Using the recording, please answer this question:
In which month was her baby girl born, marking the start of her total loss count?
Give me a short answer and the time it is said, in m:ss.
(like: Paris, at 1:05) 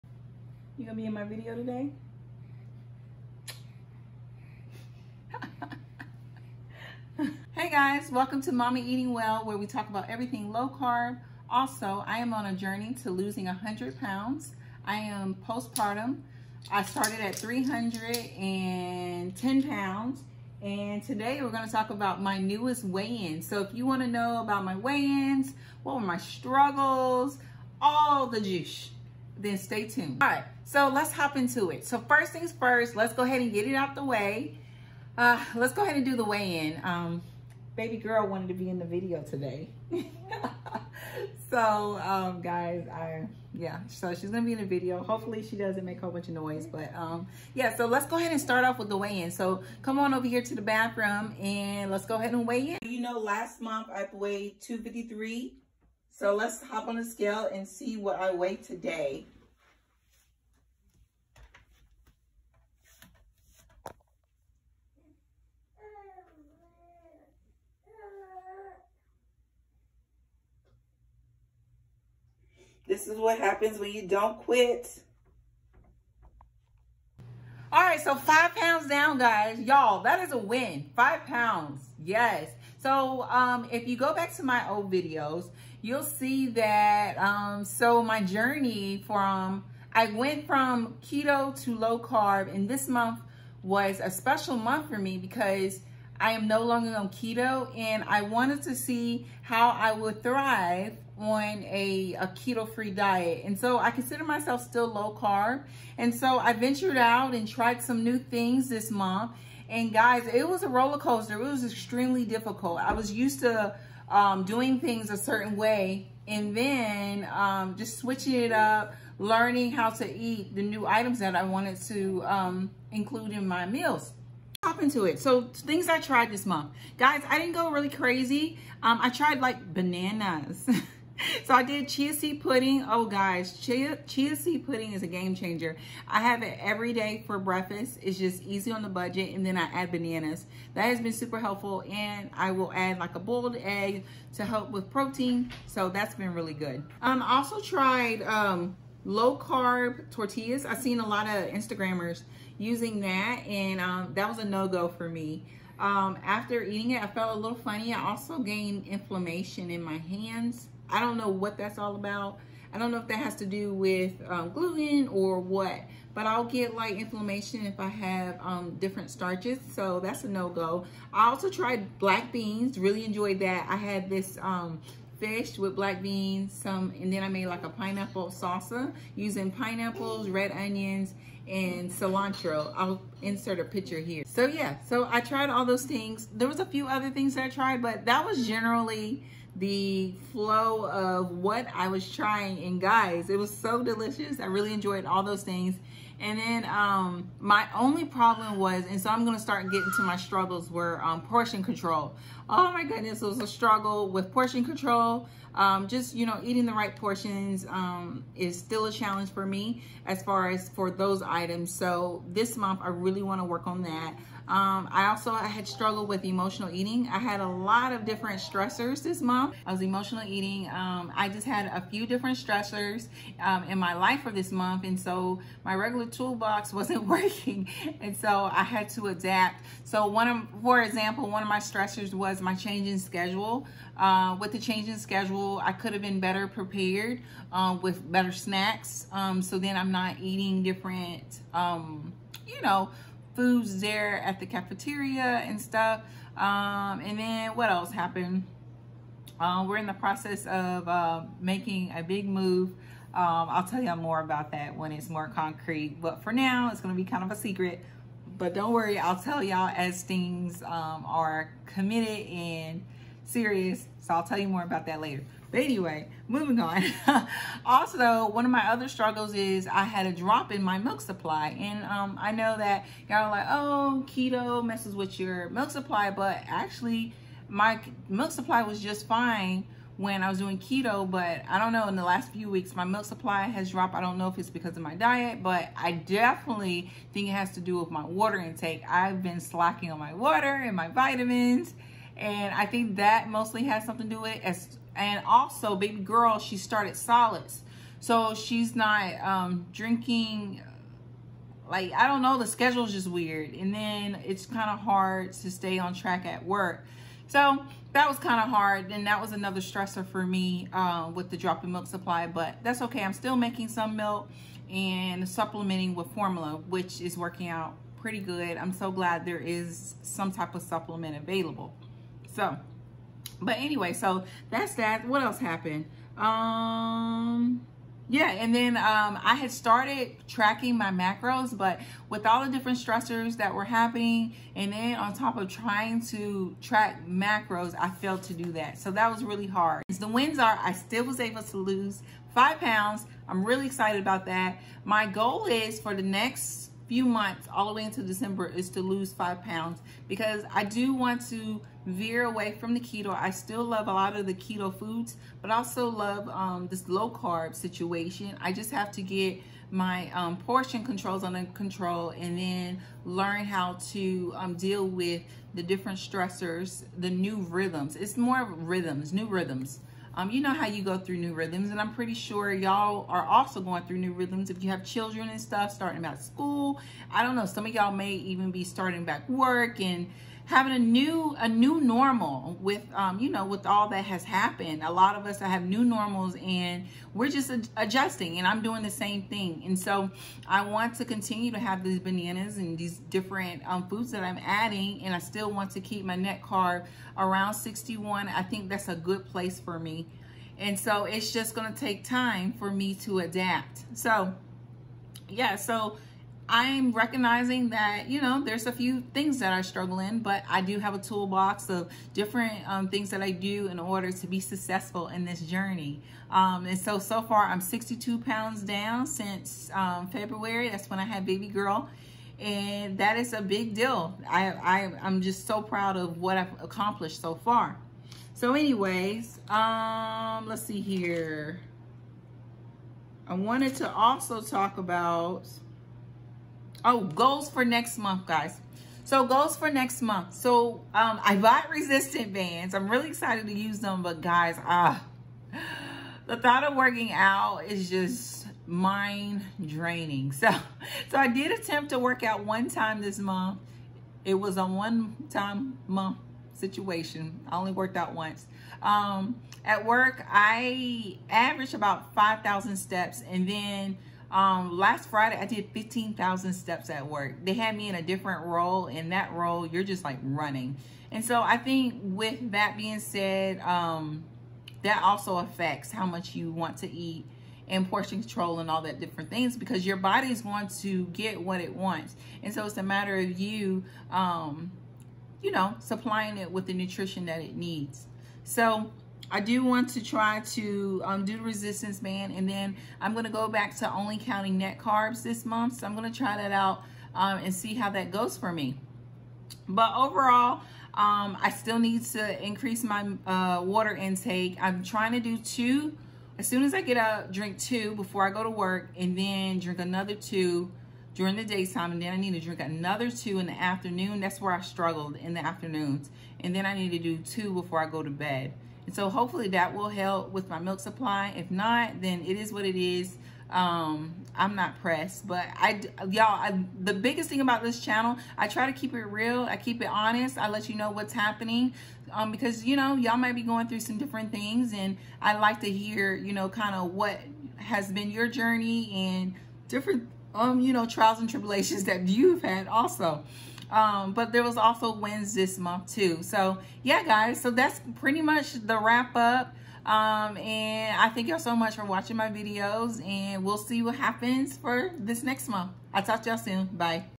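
February, at 7:00.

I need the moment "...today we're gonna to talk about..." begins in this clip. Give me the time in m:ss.
0:21.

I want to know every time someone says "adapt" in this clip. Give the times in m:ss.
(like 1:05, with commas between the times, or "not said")
3:49, 6:43.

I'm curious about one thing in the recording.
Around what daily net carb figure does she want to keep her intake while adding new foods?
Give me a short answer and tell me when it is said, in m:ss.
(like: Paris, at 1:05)
61, at 6:37.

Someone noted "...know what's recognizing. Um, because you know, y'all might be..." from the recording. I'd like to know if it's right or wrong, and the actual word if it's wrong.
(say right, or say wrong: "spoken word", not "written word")
wrong: "happening", not "recognizing".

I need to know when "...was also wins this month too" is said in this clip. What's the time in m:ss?
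9:04.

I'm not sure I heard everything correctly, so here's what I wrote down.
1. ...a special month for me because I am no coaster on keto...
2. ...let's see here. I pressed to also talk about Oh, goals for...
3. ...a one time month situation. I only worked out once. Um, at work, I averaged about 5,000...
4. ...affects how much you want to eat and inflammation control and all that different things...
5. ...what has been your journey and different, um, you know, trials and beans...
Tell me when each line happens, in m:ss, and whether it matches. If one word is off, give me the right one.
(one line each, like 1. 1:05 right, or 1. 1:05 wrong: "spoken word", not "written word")
1. 1:34 wrong: "longer", not "coaster"
2. 7:10 wrong: "wanted", not "pressed"
3. 7:34 right
4. 7:55 wrong: "portion", not "inflammation"
5. 8:56 wrong: "tribulations", not "beans".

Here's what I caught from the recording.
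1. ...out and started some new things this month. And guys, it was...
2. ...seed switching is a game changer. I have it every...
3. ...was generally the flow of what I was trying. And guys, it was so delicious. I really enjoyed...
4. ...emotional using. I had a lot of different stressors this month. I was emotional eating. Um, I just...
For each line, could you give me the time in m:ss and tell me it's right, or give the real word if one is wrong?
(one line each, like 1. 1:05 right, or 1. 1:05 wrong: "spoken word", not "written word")
1. 1:46 wrong: "tried", not "started"
2. 2:14 wrong: "pudding", not "switching"
3. 3:08 right
4. 3:36 wrong: "eating", not "using".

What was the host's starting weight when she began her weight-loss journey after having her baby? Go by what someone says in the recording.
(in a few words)
310 pounds.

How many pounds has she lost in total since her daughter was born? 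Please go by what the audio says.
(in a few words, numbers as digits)
62 pounds.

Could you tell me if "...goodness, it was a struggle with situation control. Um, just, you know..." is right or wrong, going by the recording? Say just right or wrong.
wrong.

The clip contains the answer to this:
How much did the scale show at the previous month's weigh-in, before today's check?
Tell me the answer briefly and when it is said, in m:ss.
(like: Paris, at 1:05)
253, at 0:54.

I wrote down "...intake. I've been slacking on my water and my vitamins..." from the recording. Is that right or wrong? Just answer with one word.
right.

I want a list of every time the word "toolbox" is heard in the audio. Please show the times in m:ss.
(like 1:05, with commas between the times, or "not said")
3:46, 6:50.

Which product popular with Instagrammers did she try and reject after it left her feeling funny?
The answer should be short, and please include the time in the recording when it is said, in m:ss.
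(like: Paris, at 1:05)
Low carb tortillas, at 2:29.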